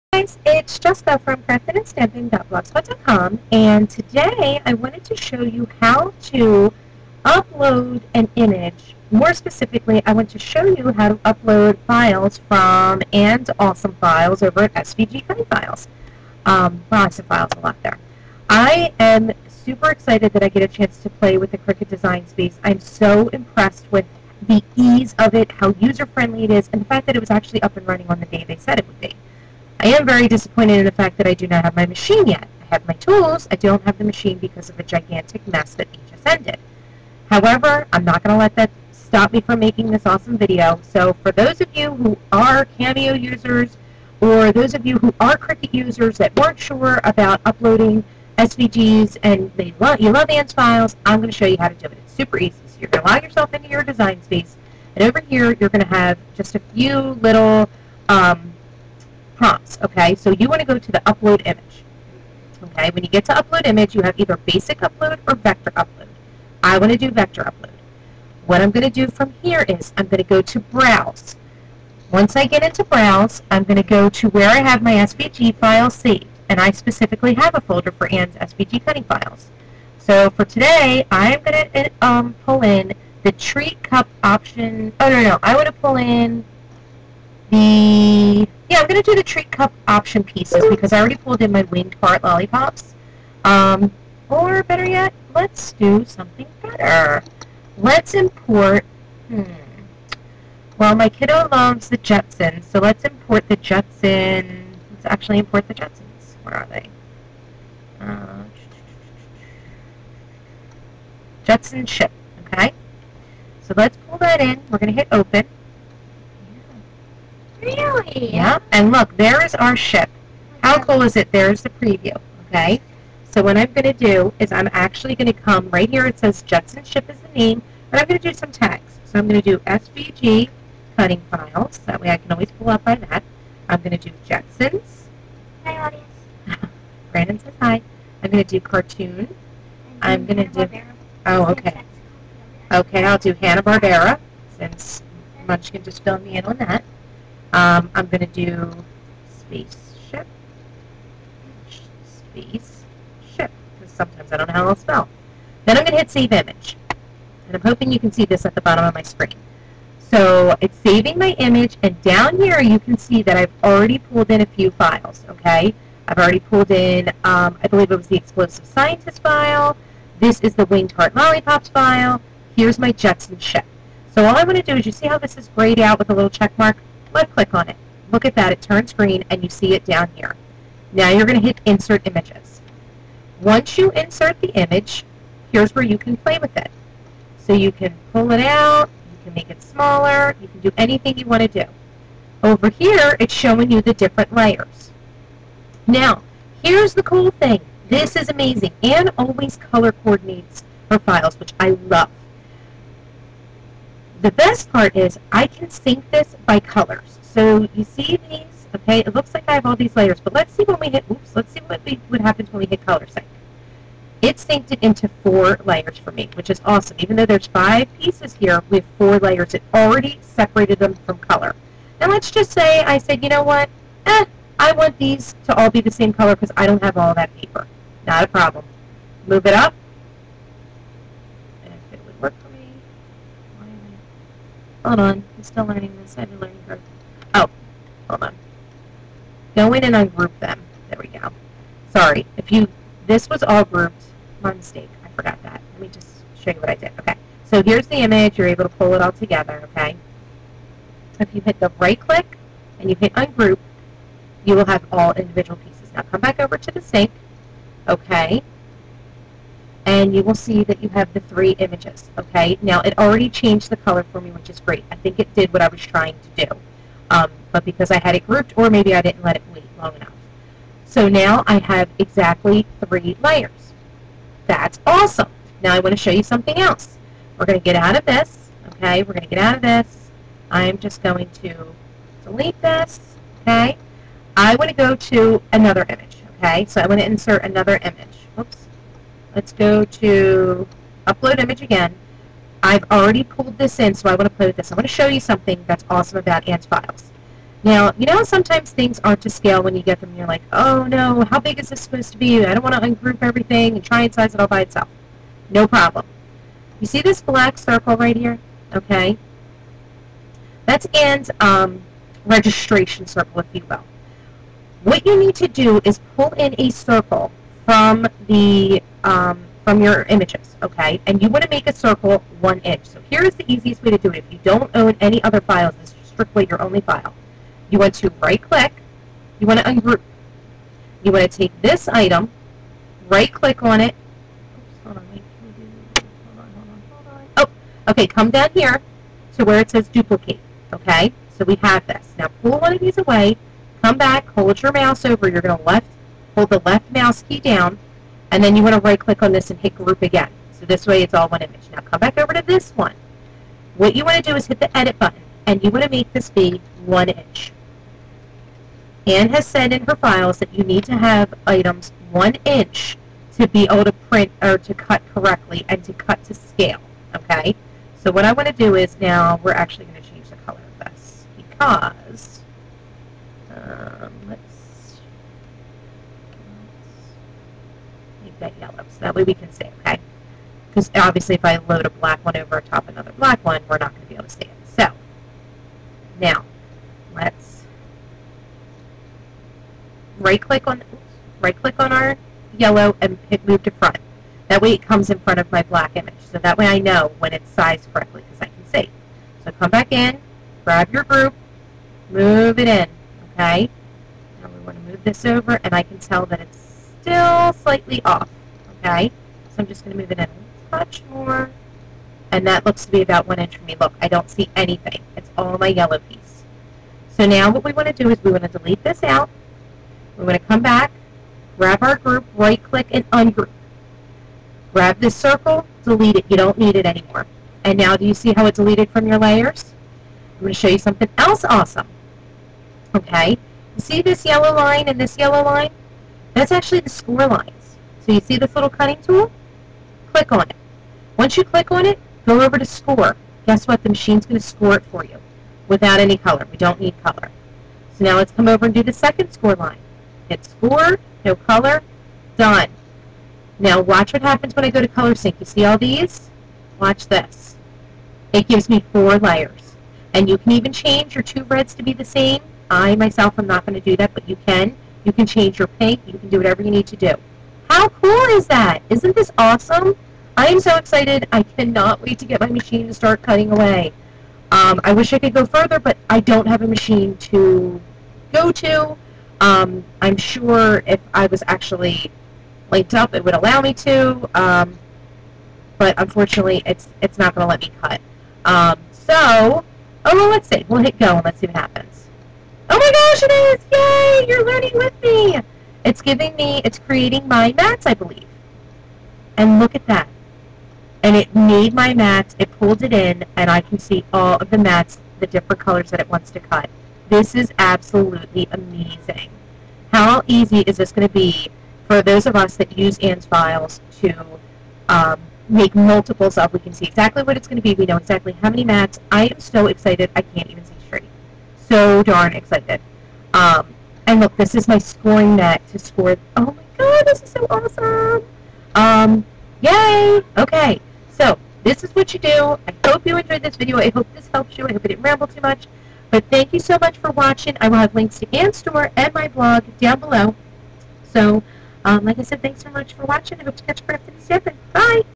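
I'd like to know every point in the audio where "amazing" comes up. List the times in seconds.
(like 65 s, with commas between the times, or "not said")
198 s, 508 s.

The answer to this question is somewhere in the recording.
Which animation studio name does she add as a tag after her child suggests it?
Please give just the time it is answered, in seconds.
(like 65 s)
143 s.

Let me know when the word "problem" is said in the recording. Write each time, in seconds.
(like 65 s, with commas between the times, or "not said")
228 s, 305 s.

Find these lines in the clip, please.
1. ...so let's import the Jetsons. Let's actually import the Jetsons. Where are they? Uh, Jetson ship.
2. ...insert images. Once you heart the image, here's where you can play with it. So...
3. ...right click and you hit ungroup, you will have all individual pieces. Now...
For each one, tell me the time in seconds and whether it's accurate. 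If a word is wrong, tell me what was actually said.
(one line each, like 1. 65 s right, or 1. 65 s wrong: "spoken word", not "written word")
1. 102 s right
2. 181 s wrong: "insert", not "heart"
3. 251 s right.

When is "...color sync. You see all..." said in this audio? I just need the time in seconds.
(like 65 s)
454 s.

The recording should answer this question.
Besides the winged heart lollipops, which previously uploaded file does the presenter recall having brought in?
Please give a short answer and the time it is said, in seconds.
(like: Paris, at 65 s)
explosive scientist, at 168 s.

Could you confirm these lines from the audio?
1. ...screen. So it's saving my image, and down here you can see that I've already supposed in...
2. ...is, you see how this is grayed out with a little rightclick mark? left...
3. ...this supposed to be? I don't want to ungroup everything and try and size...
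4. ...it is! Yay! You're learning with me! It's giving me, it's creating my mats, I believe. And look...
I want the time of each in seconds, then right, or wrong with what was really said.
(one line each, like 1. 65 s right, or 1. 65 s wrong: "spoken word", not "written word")
1. 159 s wrong: "pulled", not "supposed"
2. 174 s wrong: "check", not "rightclick"
3. 301 s right
4. 493 s right.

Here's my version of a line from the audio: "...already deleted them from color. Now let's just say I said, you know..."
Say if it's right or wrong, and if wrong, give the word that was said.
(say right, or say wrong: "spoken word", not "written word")
wrong: "separated", not "deleted".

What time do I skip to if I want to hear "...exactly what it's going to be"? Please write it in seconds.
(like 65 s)
516 s.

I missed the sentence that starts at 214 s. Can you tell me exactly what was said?
It synced it into four layers for me, which is awesome.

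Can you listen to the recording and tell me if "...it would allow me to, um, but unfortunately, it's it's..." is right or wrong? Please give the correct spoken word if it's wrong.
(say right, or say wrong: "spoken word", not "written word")
right.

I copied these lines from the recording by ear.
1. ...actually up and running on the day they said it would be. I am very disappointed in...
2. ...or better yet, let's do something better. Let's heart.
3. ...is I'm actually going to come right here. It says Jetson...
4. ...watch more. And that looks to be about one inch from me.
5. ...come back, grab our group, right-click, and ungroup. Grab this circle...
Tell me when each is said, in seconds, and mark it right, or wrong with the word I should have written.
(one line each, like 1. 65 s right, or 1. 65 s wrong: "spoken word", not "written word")
1. 27 s right
2. 94 s wrong: "import", not "heart"
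3. 124 s right
4. 410 s wrong: "touch", not "watch"
5. 420 s right.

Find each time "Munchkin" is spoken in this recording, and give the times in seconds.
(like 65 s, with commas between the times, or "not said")
145 s.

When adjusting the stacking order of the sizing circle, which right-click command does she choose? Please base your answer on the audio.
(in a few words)
move to front.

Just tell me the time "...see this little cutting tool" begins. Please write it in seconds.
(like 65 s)
438 s.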